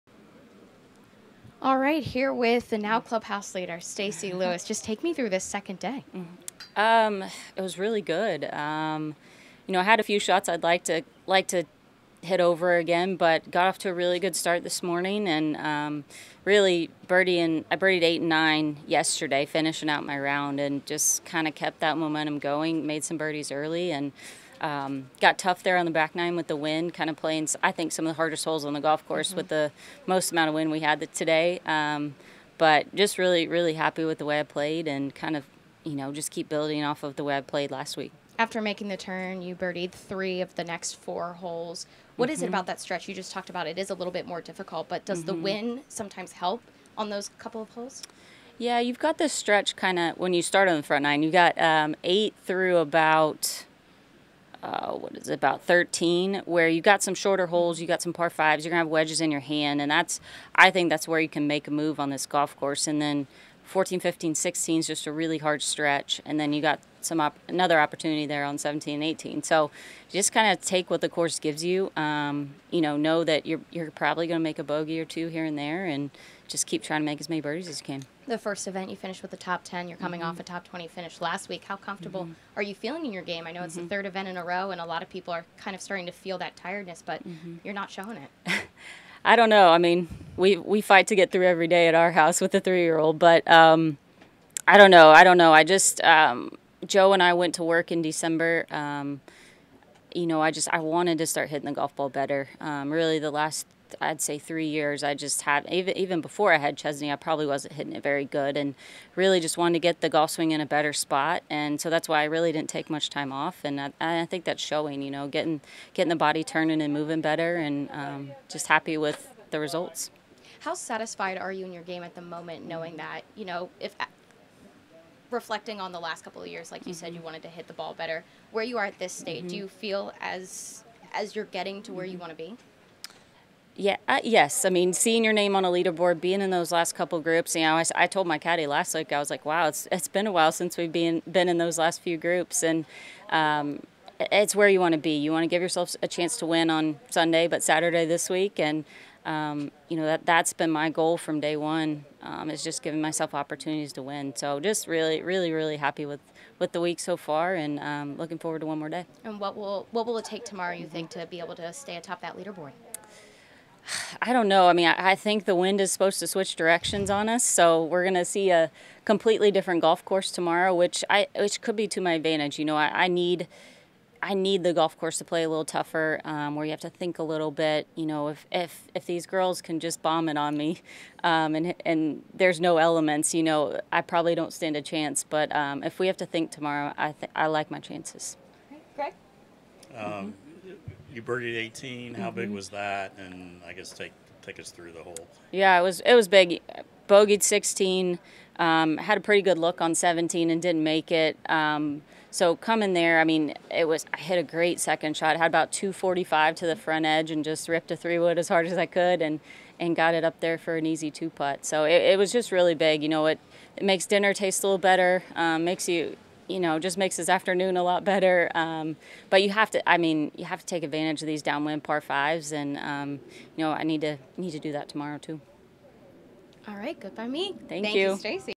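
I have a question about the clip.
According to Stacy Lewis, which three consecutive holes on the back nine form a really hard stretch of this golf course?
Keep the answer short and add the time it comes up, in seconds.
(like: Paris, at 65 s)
14, 15, 16, at 63 s.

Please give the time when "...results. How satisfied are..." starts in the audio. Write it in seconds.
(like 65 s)
119 s.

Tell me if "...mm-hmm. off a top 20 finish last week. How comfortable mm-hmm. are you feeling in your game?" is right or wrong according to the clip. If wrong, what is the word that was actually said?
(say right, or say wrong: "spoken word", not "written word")
right.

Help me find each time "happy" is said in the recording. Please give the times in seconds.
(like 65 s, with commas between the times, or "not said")
33 s, 118 s, 155 s.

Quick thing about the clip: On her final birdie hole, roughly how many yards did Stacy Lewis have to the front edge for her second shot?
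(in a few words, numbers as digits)
245.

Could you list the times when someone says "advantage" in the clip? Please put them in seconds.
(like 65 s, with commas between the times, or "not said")
172 s, 220 s.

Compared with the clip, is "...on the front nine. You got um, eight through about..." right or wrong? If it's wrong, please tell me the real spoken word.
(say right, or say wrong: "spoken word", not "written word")
right.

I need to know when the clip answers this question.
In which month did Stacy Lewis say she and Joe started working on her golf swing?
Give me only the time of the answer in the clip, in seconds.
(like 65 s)
98 s.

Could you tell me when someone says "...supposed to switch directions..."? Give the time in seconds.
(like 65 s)
165 s.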